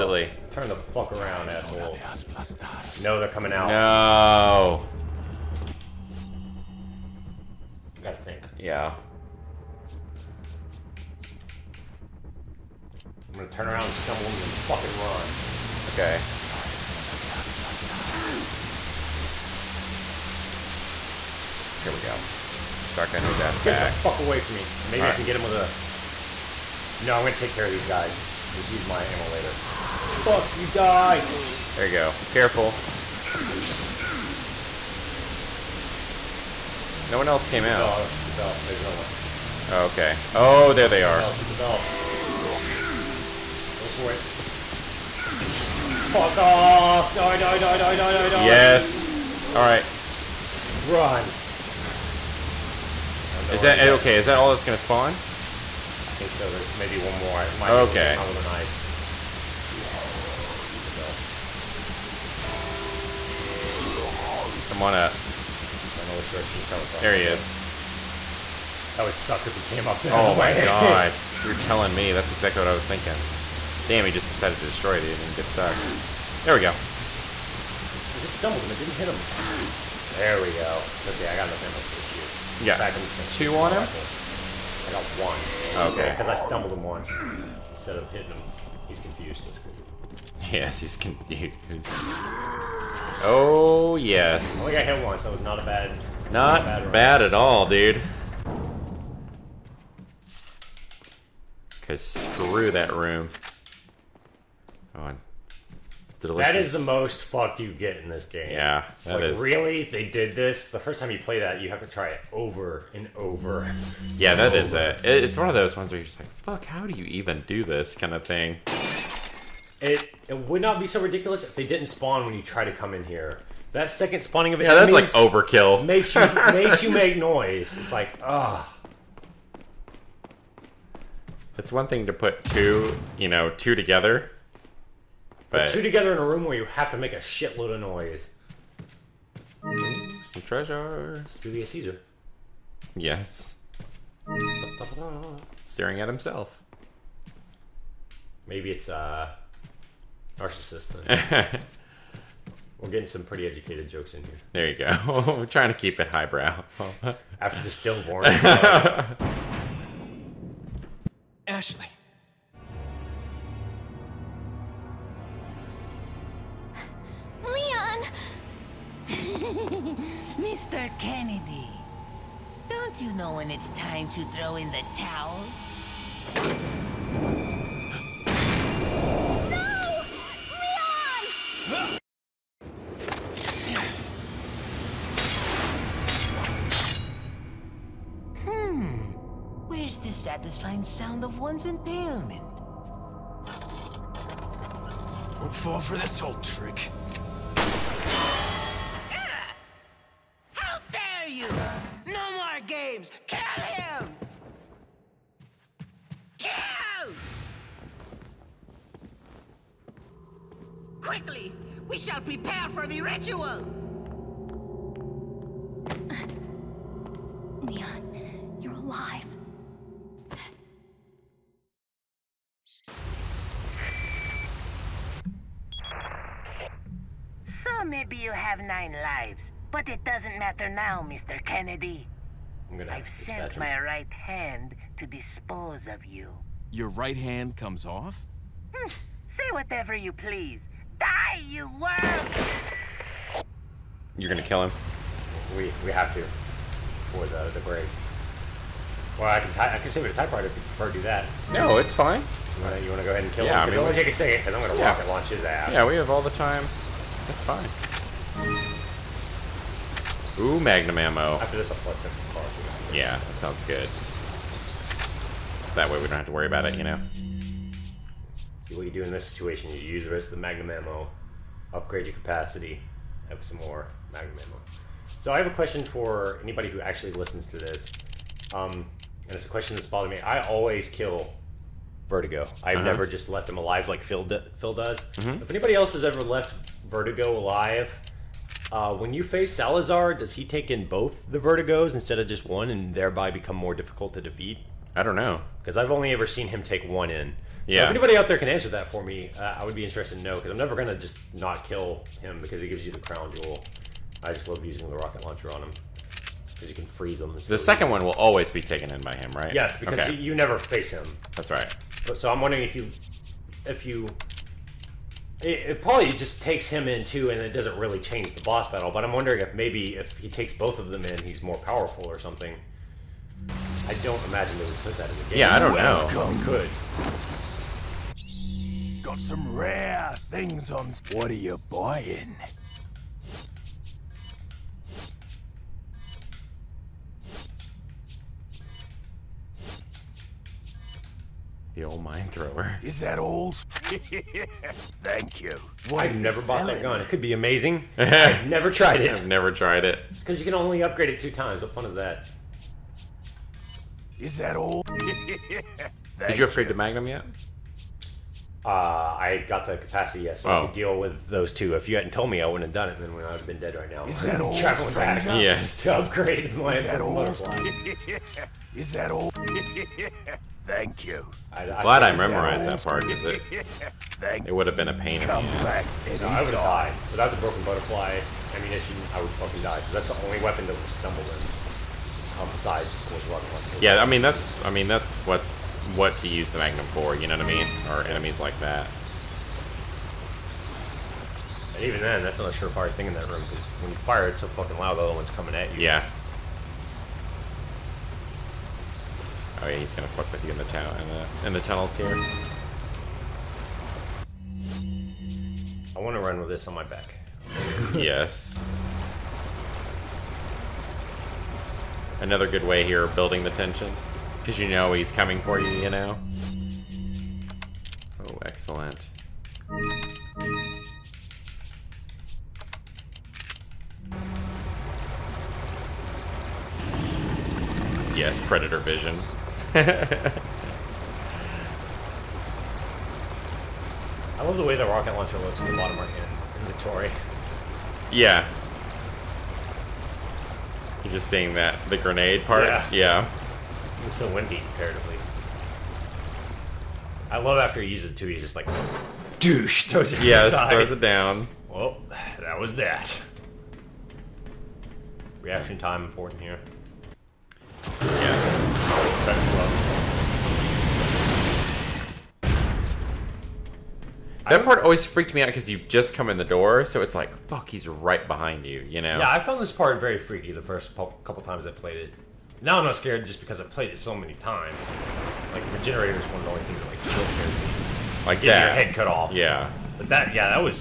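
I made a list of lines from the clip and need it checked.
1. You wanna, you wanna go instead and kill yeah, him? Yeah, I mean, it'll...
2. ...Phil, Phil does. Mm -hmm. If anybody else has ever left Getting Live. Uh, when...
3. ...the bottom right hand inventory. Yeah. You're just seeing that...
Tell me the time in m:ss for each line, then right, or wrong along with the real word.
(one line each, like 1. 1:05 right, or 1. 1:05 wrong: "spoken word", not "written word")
1. 4:12 wrong: "ahead", not "instead"
2. 4:44 wrong: "Verdugo", not "Getting"
3. 7:15 right.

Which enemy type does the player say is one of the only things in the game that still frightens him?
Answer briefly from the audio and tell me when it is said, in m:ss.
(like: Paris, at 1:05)
Regenerator, at 7:55.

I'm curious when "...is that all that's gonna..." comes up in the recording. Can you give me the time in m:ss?
0:54.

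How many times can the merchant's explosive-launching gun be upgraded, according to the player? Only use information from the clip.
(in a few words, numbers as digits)
2.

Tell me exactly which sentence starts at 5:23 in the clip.
I don't imagine they would put that in the game.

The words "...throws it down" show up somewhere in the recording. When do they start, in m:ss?
7:30.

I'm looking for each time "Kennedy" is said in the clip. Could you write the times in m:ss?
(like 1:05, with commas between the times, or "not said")
2:50, 3:51.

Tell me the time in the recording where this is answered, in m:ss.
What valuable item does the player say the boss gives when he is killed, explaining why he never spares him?
5:02.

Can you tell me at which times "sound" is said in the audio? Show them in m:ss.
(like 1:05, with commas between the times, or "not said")
3:10, 4:23.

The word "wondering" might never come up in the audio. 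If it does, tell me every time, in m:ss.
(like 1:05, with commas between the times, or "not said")
5:12, 5:19.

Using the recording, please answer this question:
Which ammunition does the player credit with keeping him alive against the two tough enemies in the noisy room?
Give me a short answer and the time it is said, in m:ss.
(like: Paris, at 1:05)
broken butterfly, at 6:17.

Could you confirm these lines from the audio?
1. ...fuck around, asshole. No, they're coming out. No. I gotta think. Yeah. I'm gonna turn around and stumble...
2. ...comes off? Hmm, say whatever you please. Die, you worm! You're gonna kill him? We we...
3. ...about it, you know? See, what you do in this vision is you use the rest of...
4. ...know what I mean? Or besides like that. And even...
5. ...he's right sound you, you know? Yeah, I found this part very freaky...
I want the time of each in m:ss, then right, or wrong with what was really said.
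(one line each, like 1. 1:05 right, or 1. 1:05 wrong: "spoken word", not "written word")
1. 0:00 right
2. 3:57 right
3. 4:26 wrong: "situation", not "vision"
4. 6:27 wrong: "enemies", not "besides"
5. 7:47 wrong: "behind", not "sound".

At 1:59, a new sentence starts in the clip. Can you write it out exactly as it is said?
It it would not be so ridiculous if they didn't spawn when you try to come in here.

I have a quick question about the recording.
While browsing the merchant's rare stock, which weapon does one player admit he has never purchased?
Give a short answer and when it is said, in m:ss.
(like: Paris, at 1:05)
mine thrower, at 5:42.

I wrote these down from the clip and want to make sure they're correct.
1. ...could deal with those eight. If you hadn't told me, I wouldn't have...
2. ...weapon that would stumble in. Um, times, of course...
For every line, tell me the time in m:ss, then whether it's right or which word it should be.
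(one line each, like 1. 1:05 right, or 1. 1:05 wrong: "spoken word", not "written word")
1. 6:00 wrong: "two", not "eight"
2. 6:20 wrong: "besides", not "times".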